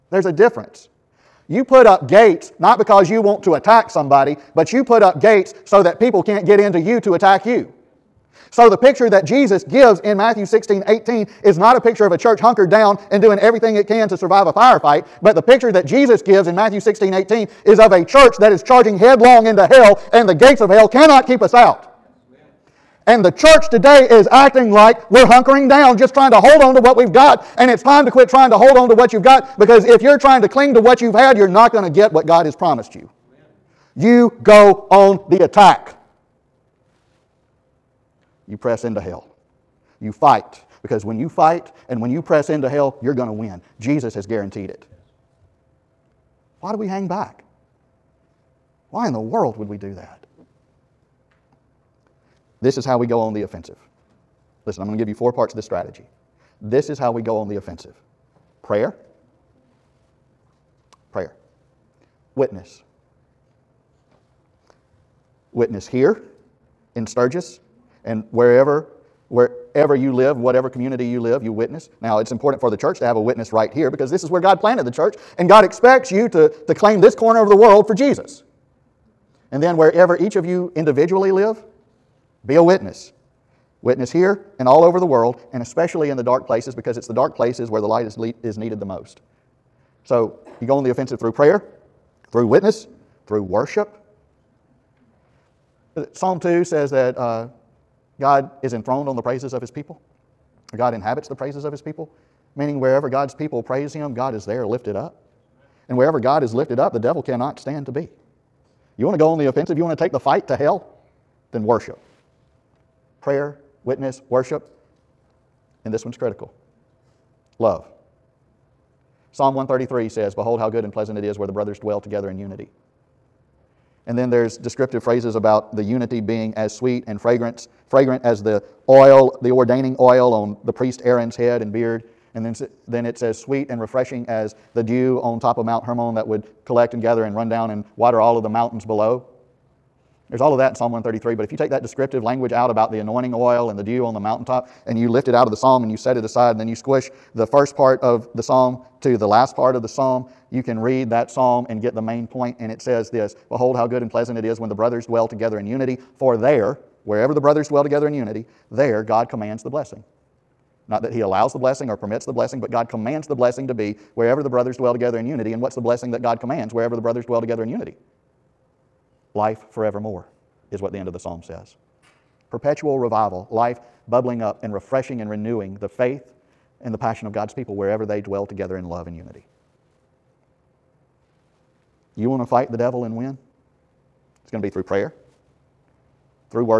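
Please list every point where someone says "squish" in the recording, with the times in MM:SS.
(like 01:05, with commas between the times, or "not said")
02:26.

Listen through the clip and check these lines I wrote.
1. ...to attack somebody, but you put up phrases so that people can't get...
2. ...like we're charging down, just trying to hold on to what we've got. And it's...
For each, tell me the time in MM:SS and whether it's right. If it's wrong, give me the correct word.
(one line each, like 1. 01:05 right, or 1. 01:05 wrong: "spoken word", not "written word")
1. 00:03 wrong: "gates", not "phrases"
2. 00:24 wrong: "hunkering", not "charging".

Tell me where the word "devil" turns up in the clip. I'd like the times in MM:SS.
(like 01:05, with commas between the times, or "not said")
01:46, 03:02.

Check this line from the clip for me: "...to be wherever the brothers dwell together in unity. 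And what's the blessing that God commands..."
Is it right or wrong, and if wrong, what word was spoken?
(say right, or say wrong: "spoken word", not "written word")
right.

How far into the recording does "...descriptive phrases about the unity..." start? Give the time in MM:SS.
02:04.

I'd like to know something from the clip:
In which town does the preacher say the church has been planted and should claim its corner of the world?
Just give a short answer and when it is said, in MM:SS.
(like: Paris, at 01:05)
Sturgis, at 01:07.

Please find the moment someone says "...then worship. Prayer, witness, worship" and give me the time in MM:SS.
01:51.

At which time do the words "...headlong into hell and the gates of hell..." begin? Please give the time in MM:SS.
00:18.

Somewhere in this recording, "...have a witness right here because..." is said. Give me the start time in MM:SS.
01:13.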